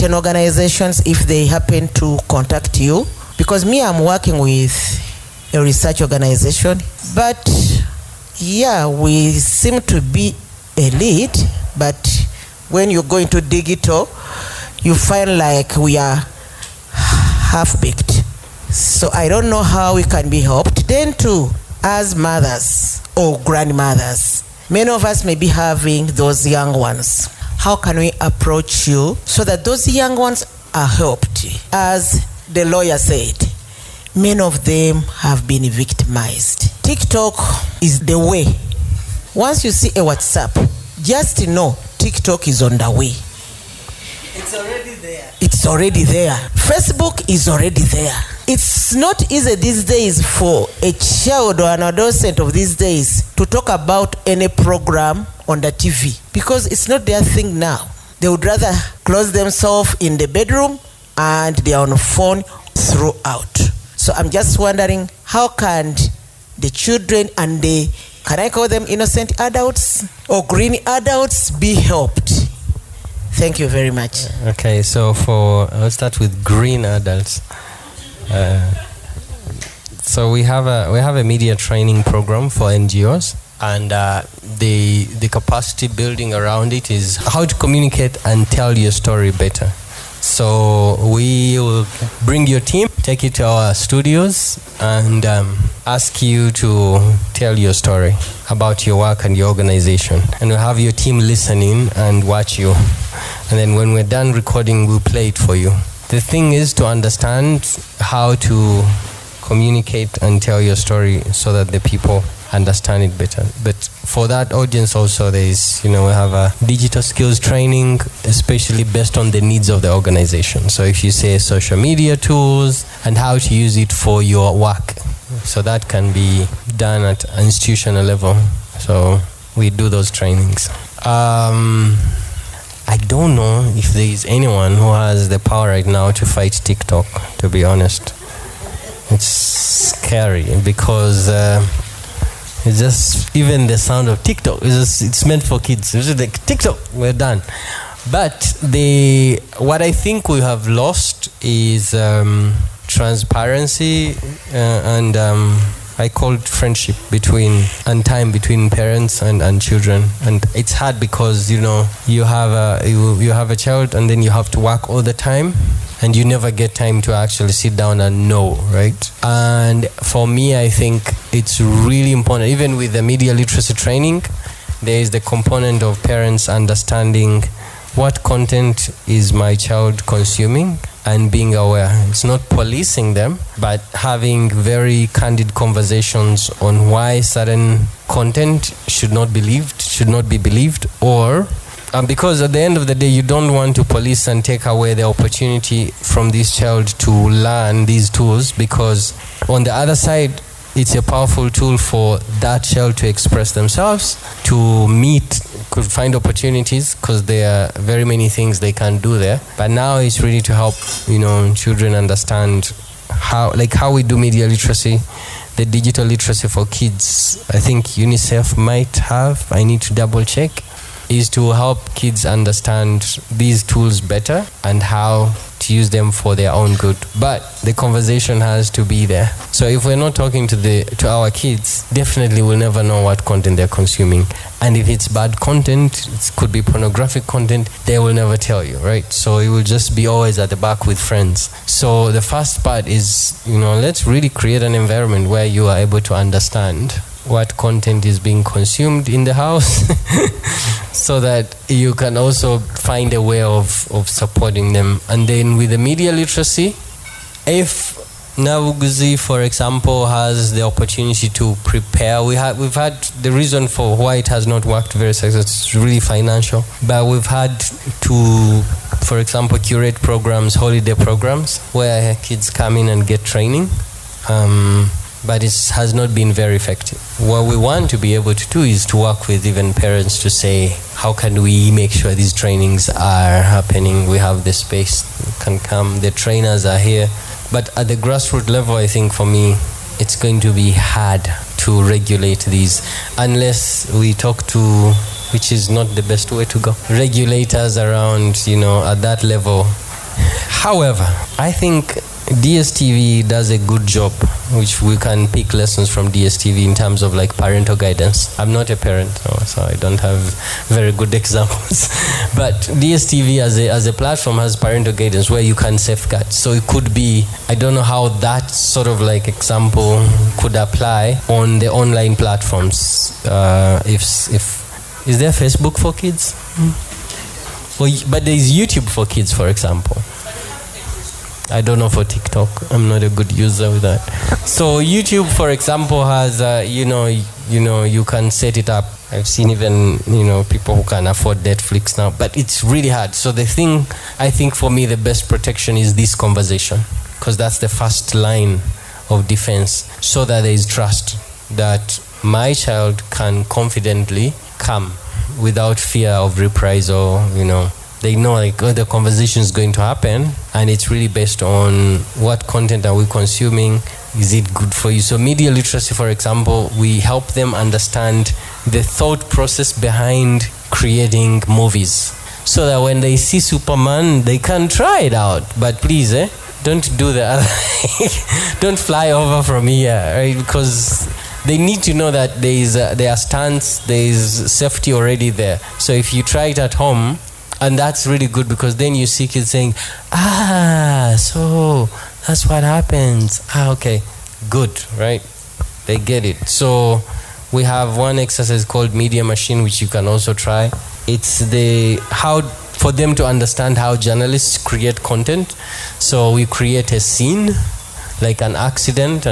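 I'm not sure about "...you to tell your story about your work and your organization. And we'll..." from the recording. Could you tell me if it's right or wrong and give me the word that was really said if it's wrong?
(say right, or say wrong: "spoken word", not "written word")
right.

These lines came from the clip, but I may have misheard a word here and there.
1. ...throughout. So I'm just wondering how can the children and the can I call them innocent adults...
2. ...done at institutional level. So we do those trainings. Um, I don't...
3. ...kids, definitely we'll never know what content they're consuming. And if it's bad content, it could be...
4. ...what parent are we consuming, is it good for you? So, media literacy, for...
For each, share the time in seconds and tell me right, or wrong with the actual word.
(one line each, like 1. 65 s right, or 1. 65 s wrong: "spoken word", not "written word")
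1. 62 s right
2. 126 s right
3. 231 s right
4. 362 s wrong: "content", not "parent".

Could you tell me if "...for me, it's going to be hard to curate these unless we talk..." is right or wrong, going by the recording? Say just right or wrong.
wrong.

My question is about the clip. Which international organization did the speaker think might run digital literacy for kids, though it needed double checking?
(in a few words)
UNICEF.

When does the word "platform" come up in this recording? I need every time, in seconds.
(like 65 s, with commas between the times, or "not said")
313 s, 322 s.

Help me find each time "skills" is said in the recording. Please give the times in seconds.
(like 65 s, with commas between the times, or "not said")
117 s.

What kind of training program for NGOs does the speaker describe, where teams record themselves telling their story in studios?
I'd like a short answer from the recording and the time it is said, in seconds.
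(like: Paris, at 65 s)
media training program, at 81 s.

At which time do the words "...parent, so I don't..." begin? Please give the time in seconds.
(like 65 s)
308 s.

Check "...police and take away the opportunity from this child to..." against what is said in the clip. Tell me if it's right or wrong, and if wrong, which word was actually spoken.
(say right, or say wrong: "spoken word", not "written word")
right.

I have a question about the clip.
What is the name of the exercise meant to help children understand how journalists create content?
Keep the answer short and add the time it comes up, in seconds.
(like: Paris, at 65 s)
Media Machine, at 398 s.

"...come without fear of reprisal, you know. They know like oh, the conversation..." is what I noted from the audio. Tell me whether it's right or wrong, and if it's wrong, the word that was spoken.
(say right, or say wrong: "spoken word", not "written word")
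right.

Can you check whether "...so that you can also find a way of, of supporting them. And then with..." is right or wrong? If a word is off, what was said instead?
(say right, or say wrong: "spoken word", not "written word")
right.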